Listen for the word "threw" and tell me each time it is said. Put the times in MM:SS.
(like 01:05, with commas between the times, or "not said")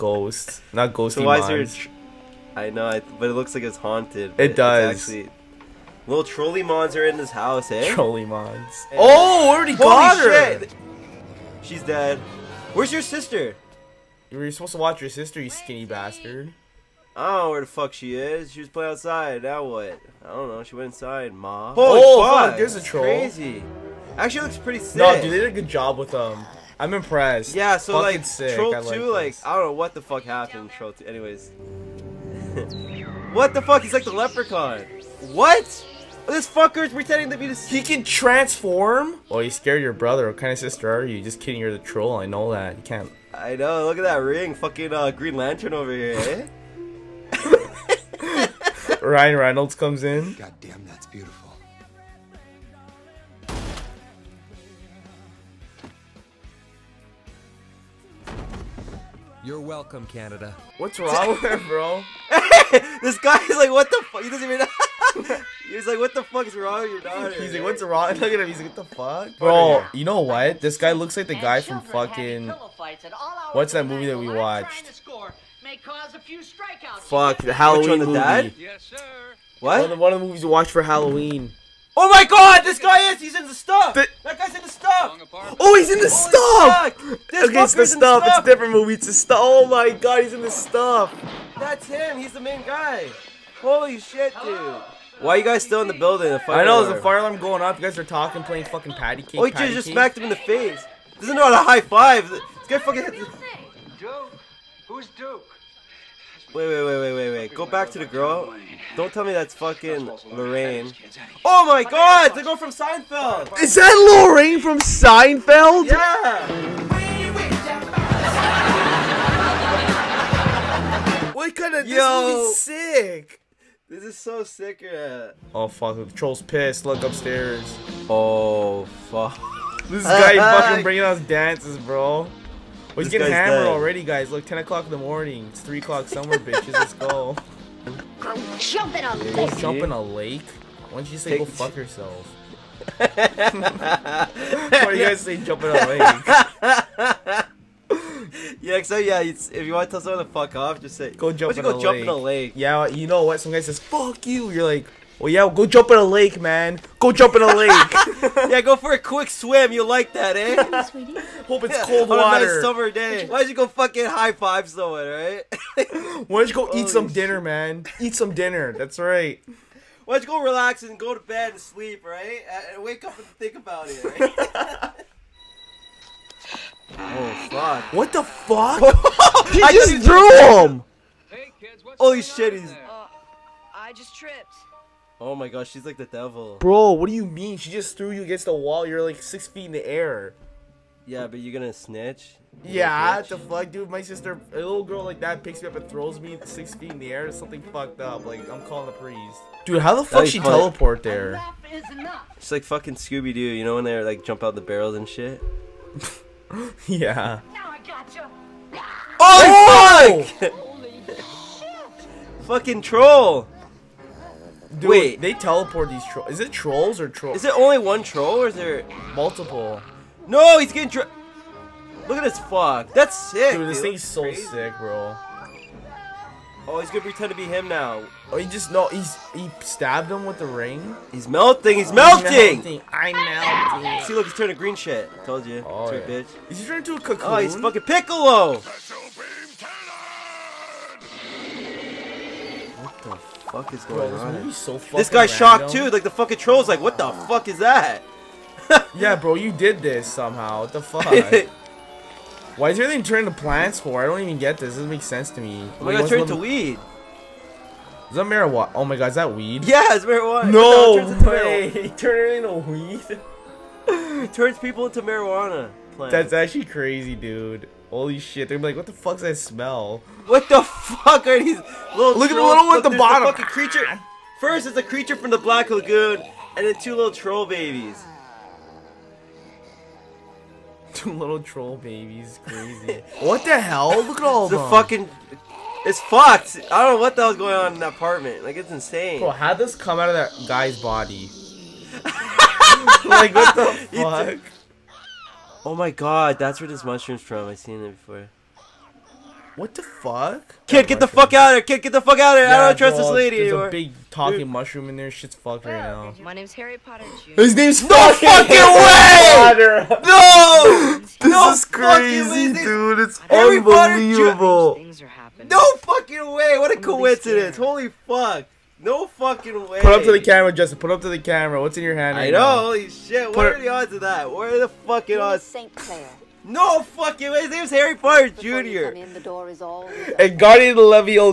02:59, 03:07.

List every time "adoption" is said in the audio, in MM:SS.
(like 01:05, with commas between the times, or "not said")
not said.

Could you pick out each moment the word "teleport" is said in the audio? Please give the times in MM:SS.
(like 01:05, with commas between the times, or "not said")
03:20, 03:35.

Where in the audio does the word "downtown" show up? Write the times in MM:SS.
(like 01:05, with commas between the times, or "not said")
not said.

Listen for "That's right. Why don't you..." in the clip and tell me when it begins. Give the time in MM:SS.
02:48.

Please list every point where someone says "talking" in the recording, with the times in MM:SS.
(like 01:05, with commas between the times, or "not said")
01:38, 05:04.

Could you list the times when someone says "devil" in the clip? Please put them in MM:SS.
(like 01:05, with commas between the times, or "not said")
03:06.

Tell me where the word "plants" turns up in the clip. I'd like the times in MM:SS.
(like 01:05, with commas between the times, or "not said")
04:13, 04:25.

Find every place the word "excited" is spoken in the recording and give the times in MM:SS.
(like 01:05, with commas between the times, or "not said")
not said.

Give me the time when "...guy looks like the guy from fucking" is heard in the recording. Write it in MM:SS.
01:10.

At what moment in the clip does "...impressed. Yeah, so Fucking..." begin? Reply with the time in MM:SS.
00:26.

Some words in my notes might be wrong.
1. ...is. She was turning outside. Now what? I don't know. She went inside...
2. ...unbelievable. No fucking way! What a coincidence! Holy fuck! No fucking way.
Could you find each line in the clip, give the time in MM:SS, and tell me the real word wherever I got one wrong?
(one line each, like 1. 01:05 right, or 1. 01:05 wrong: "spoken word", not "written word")
1. 00:18 wrong: "playing", not "turning"
2. 05:13 right.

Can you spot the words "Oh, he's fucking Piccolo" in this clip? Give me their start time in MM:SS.
03:57.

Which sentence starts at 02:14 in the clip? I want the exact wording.
Look, 10 o'clock in the morning.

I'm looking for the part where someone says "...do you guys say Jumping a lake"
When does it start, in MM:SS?
02:24.